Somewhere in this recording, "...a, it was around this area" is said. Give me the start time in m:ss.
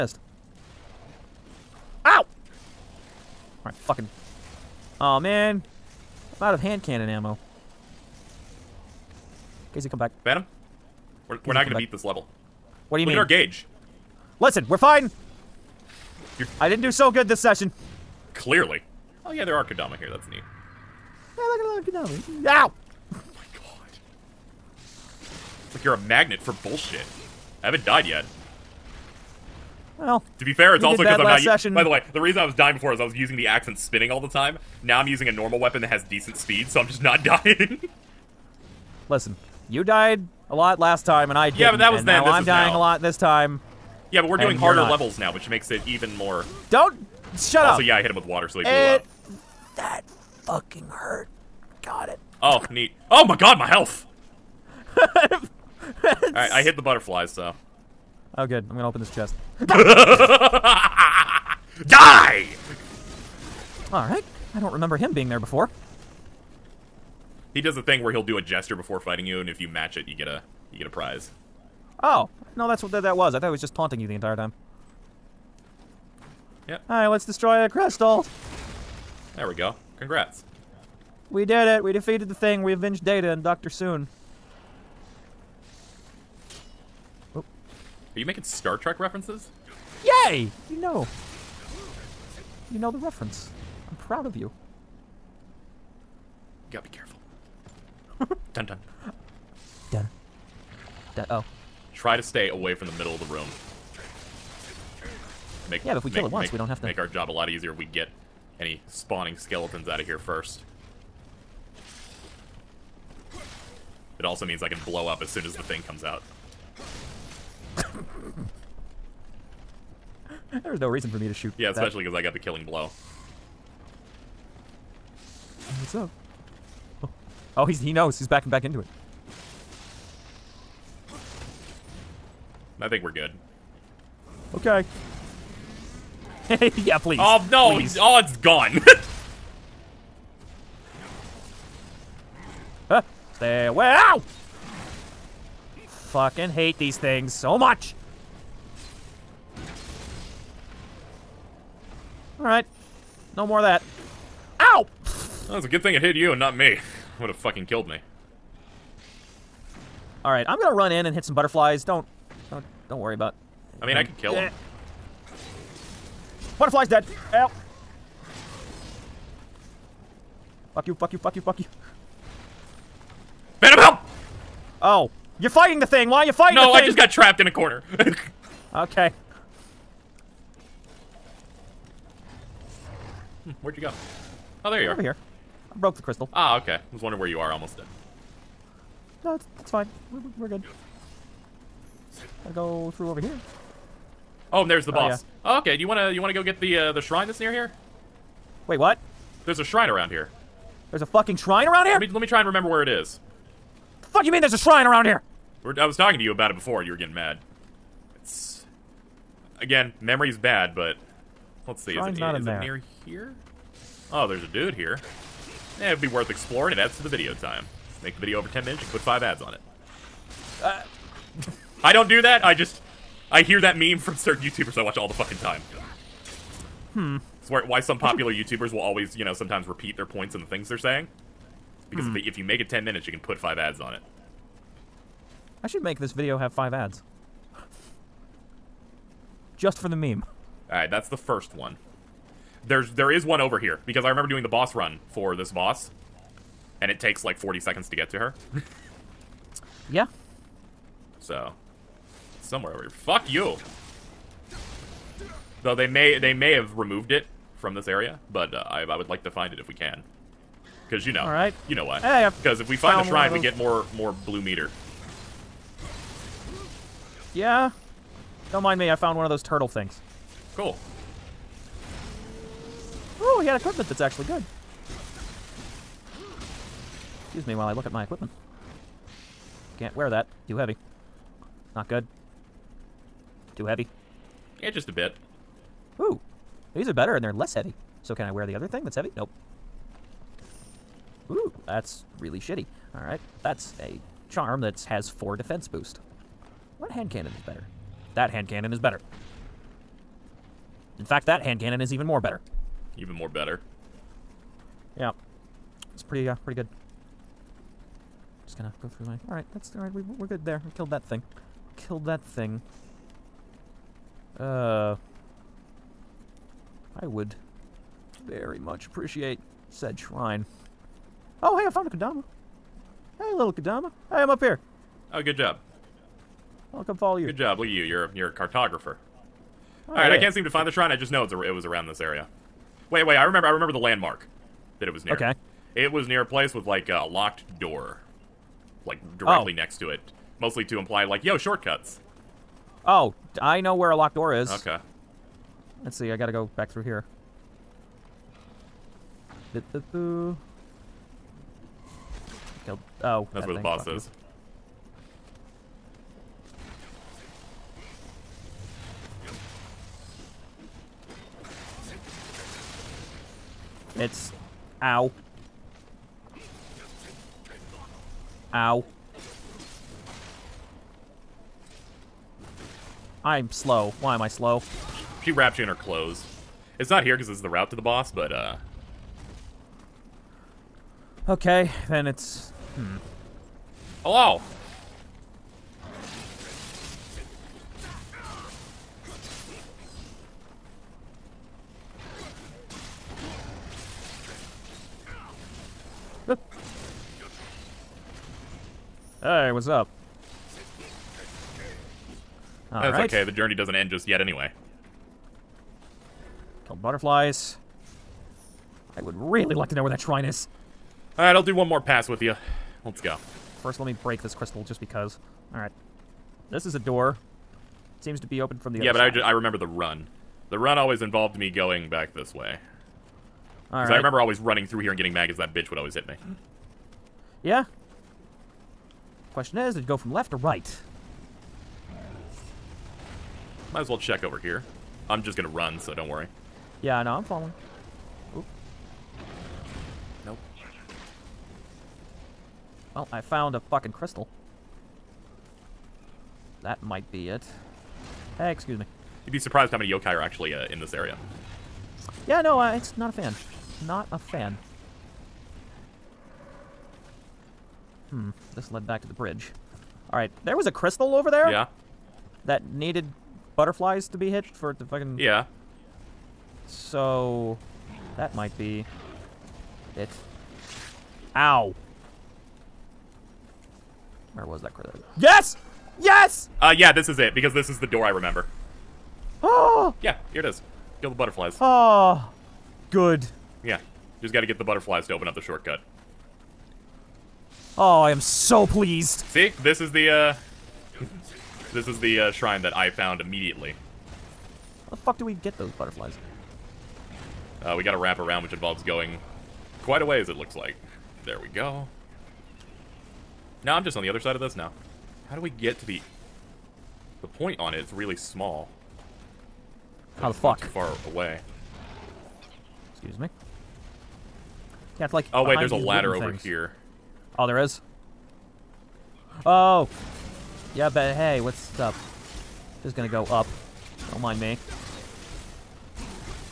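5:31.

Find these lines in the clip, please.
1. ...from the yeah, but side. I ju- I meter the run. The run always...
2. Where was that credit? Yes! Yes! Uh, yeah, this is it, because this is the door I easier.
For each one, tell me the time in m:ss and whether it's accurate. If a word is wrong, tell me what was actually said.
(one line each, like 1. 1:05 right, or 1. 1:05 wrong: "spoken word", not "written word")
1. 6:58 wrong: "remember", not "meter"
2. 7:54 wrong: "remember", not "easier".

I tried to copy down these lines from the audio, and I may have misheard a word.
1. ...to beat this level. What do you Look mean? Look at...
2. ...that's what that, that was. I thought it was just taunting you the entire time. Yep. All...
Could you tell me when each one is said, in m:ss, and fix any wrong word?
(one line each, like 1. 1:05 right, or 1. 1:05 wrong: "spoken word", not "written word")
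1. 0:11 right
2. 1:12 right.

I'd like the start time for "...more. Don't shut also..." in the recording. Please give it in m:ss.
0:46.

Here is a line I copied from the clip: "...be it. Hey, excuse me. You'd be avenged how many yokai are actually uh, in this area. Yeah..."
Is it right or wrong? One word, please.
wrong.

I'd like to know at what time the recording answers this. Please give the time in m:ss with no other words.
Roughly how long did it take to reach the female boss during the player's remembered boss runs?
4:07.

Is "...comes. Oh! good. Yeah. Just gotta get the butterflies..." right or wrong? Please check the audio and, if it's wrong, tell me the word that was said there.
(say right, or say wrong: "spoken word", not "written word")
wrong: "butterflies", not "comes".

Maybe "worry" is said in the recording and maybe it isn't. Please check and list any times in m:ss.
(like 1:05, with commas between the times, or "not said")
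2:42, 7:16.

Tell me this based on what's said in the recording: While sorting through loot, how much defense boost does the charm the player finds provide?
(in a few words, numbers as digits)
4.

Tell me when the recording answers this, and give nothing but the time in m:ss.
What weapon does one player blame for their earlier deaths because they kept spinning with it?
0:33.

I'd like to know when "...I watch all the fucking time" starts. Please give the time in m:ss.
3:44.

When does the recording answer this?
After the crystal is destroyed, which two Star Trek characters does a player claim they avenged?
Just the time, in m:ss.
1:23.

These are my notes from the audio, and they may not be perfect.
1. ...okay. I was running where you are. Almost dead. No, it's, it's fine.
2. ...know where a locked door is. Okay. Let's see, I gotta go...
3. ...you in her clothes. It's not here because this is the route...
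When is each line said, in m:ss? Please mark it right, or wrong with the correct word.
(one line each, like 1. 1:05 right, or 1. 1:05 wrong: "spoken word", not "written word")
1. 3:06 wrong: "wondering", not "running"
2. 5:43 right
3. 6:15 right.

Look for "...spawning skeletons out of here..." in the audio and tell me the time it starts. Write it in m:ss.
1:48.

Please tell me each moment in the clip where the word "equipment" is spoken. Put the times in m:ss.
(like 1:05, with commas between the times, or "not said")
4:33, 4:38.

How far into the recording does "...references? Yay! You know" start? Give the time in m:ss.
1:28.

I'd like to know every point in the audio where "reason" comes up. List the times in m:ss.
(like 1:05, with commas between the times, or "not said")
0:32, 2:00.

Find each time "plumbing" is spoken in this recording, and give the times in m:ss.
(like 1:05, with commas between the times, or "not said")
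not said.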